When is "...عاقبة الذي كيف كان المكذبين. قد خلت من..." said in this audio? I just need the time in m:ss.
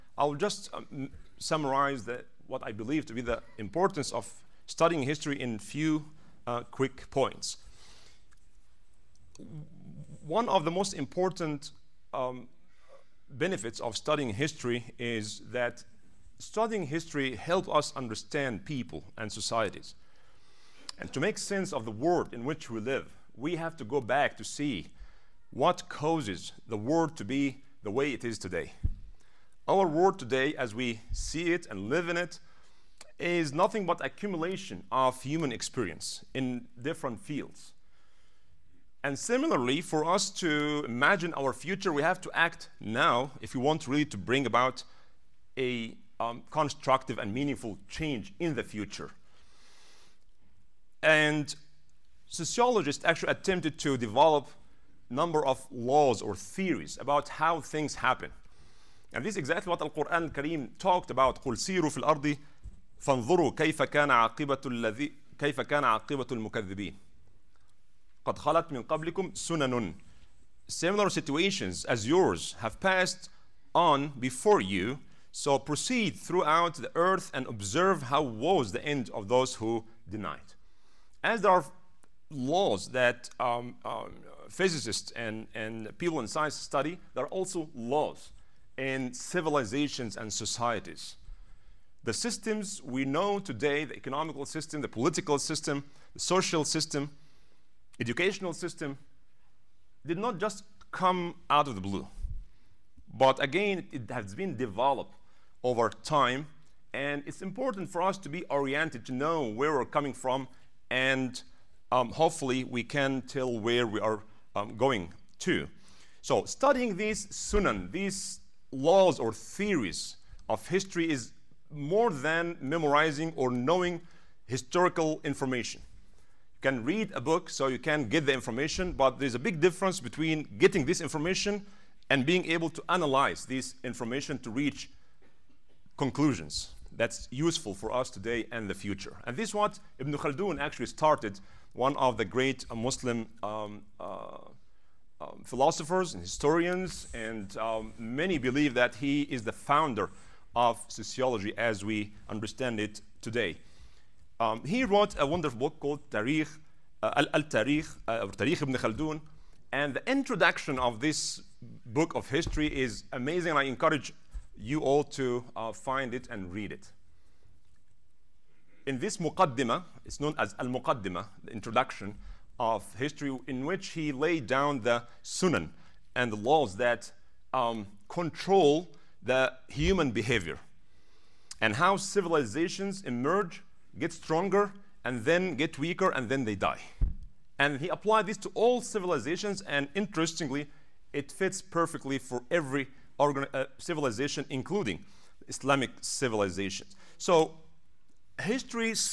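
1:04.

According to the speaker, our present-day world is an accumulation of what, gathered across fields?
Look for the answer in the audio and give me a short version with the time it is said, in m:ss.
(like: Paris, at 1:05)
human experience, at 0:35.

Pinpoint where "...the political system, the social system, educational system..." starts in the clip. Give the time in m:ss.
1:34.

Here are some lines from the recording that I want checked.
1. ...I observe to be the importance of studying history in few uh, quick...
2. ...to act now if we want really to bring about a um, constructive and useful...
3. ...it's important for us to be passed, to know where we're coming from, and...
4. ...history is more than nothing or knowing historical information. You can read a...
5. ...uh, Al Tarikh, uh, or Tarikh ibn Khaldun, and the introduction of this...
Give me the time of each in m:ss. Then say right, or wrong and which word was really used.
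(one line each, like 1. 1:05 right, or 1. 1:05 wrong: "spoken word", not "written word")
1. 0:02 wrong: "believe", not "observe"
2. 0:42 wrong: "meaningful", not "useful"
3. 1:47 wrong: "oriented", not "passed"
4. 2:00 wrong: "memorizing", not "nothing"
5. 2:37 right.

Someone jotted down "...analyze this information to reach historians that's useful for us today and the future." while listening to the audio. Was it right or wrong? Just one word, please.
wrong.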